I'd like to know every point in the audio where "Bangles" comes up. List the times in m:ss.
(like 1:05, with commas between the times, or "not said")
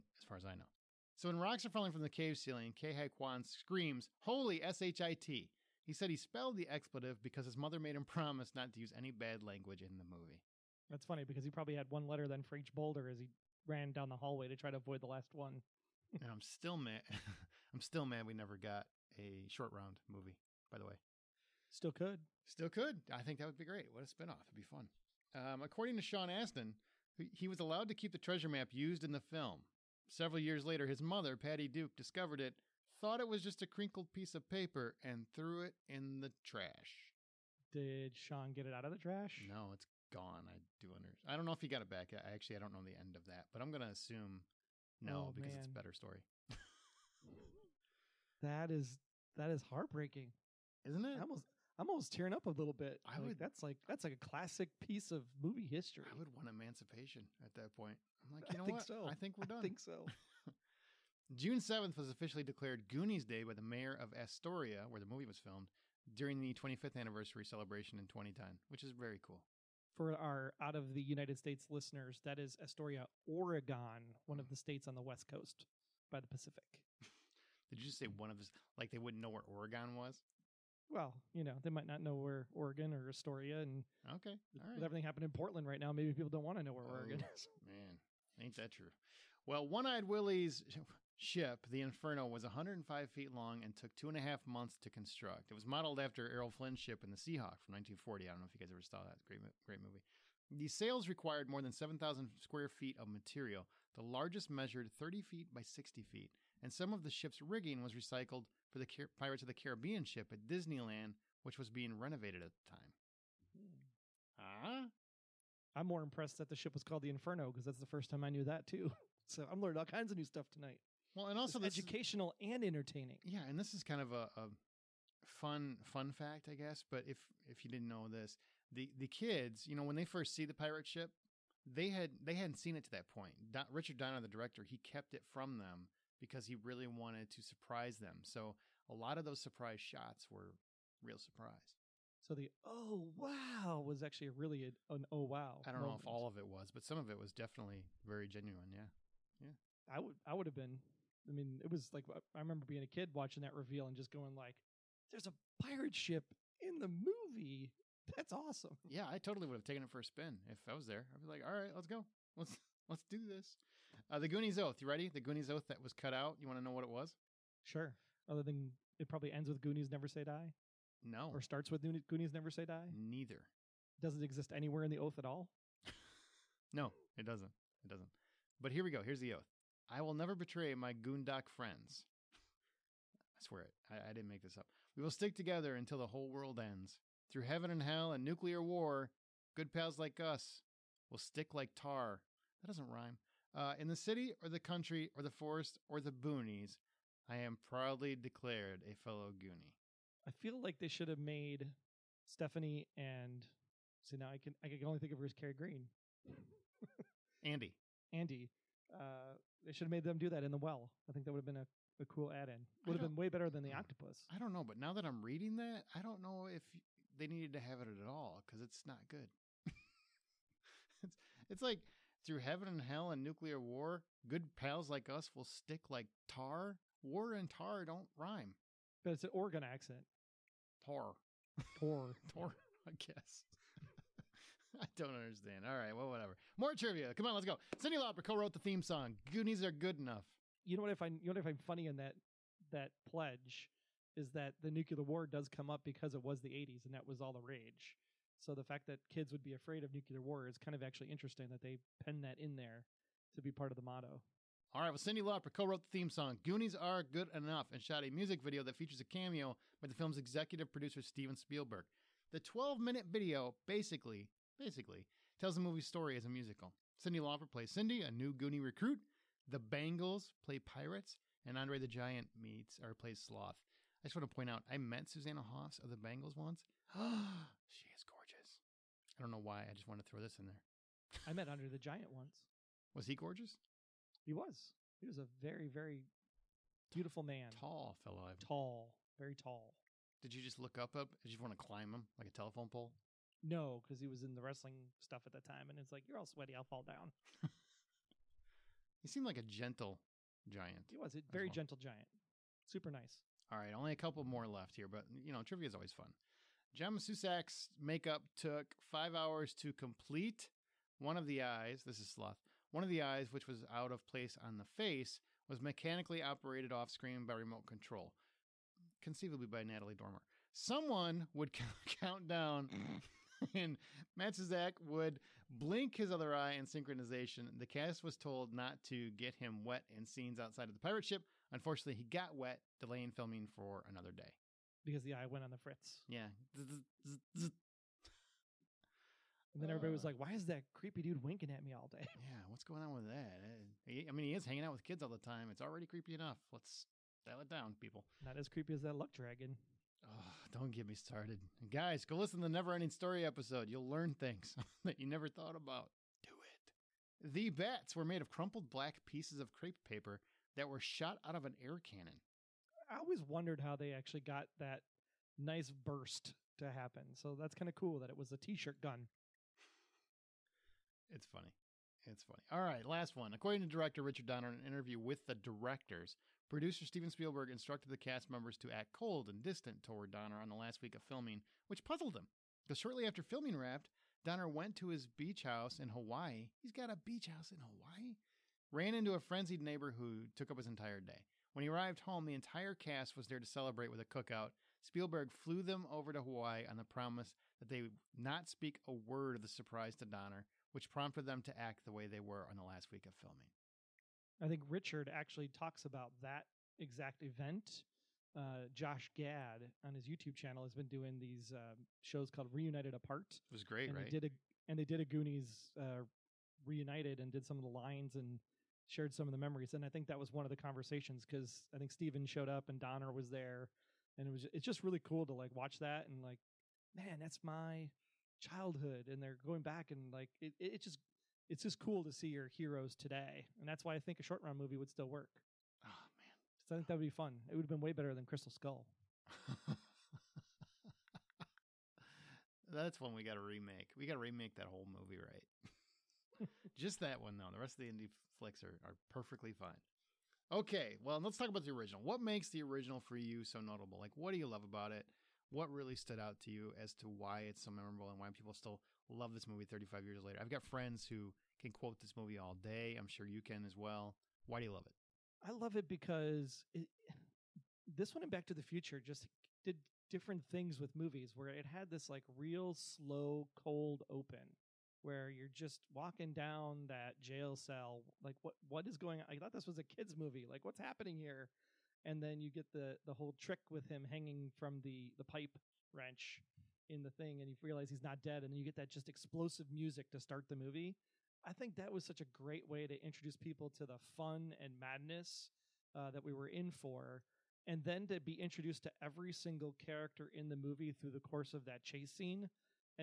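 4:29, 4:35.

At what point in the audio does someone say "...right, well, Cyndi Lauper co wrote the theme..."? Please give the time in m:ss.
4:14.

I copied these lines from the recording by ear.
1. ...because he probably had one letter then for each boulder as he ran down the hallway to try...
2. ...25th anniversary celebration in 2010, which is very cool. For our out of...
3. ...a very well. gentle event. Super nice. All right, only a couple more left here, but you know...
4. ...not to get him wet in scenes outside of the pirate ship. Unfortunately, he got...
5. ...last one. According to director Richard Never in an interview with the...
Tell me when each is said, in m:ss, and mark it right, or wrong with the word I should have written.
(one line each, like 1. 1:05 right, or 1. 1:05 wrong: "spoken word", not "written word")
1. 0:11 right
2. 1:06 right
3. 5:01 wrong: "giant", not "event"
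4. 5:28 right
5. 6:12 wrong: "Donner", not "Never".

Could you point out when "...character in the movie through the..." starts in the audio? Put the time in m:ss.
8:19.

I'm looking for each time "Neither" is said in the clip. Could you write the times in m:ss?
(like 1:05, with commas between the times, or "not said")
2:52.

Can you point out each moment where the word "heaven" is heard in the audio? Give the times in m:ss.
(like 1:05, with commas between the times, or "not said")
3:07, 3:42.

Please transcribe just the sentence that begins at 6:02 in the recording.
I always wondered how they actually got that nice burst to happen.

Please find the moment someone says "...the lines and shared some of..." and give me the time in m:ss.
6:57.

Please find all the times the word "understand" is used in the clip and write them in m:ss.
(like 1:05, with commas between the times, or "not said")
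0:40, 3:55.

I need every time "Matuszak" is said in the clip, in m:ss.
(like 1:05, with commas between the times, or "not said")
5:06, 5:24.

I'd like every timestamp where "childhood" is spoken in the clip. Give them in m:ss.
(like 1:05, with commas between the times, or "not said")
7:08.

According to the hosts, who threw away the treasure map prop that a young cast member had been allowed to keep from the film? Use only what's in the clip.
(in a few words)
Patty Duke.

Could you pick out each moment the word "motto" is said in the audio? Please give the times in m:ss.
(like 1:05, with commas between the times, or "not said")
4:13.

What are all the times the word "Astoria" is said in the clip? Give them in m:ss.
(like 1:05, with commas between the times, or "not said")
1:04, 1:12, 1:23.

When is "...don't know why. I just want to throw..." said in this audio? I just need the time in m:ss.
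4:39.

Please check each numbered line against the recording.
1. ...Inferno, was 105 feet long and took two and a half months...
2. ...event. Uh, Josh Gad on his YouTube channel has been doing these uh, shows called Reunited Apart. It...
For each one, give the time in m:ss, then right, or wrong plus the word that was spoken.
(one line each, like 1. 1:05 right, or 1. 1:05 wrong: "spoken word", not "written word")
1. 1:31 right
2. 6:47 right.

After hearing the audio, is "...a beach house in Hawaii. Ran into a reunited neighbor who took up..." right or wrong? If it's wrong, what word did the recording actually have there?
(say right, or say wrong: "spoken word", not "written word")
wrong: "frenzied", not "reunited".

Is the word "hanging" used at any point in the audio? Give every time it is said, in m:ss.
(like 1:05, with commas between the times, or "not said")
5:44, 8:04.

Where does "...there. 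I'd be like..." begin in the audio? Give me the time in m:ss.
2:40.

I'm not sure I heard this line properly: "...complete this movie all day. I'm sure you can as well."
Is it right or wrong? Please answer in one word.
wrong.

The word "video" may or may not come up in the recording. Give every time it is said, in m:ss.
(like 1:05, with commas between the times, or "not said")
4:18, 4:23.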